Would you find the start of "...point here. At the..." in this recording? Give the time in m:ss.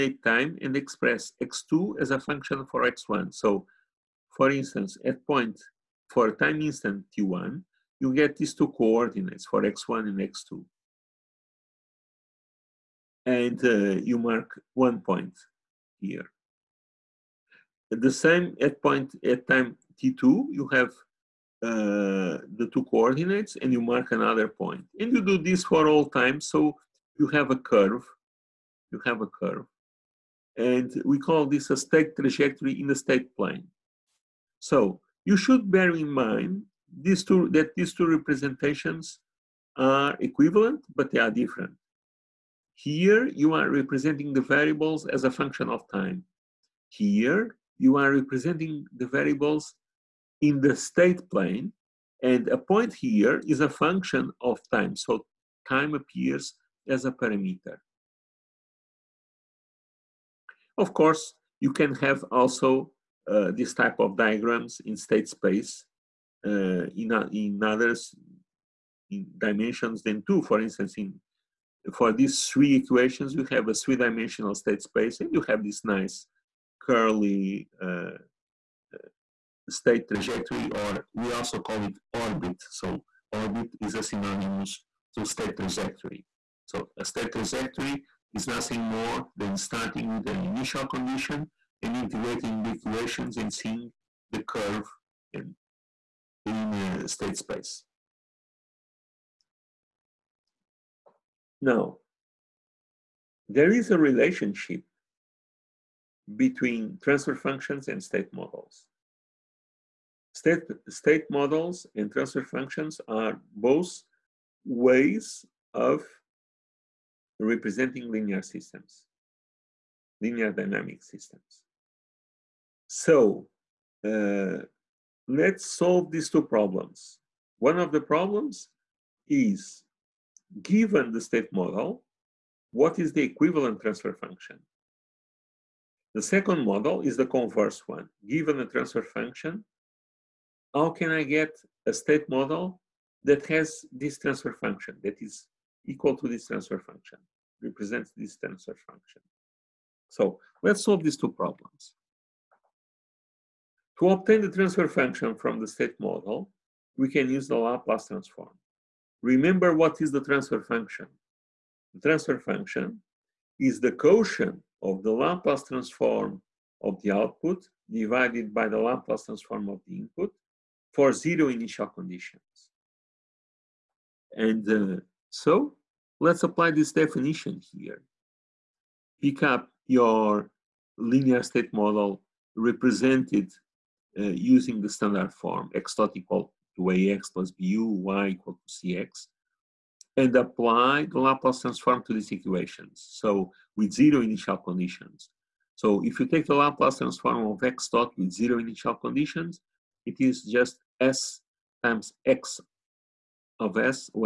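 0:15.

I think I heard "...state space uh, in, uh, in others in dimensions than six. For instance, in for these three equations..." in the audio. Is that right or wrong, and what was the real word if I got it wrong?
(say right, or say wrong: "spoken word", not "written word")
wrong: "two", not "six".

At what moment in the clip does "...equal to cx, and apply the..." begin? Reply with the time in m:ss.
3:08.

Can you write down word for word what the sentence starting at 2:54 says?
And uh, so let's apply this definition here.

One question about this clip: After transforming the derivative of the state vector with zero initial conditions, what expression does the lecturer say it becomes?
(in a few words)
s times x of s.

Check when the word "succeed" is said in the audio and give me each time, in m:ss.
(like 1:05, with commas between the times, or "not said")
not said.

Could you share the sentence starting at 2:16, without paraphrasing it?
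The second model is the converse one.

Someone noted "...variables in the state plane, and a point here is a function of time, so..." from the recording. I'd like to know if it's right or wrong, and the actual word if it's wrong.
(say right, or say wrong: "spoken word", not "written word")
right.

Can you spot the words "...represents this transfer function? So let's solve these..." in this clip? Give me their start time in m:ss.
2:27.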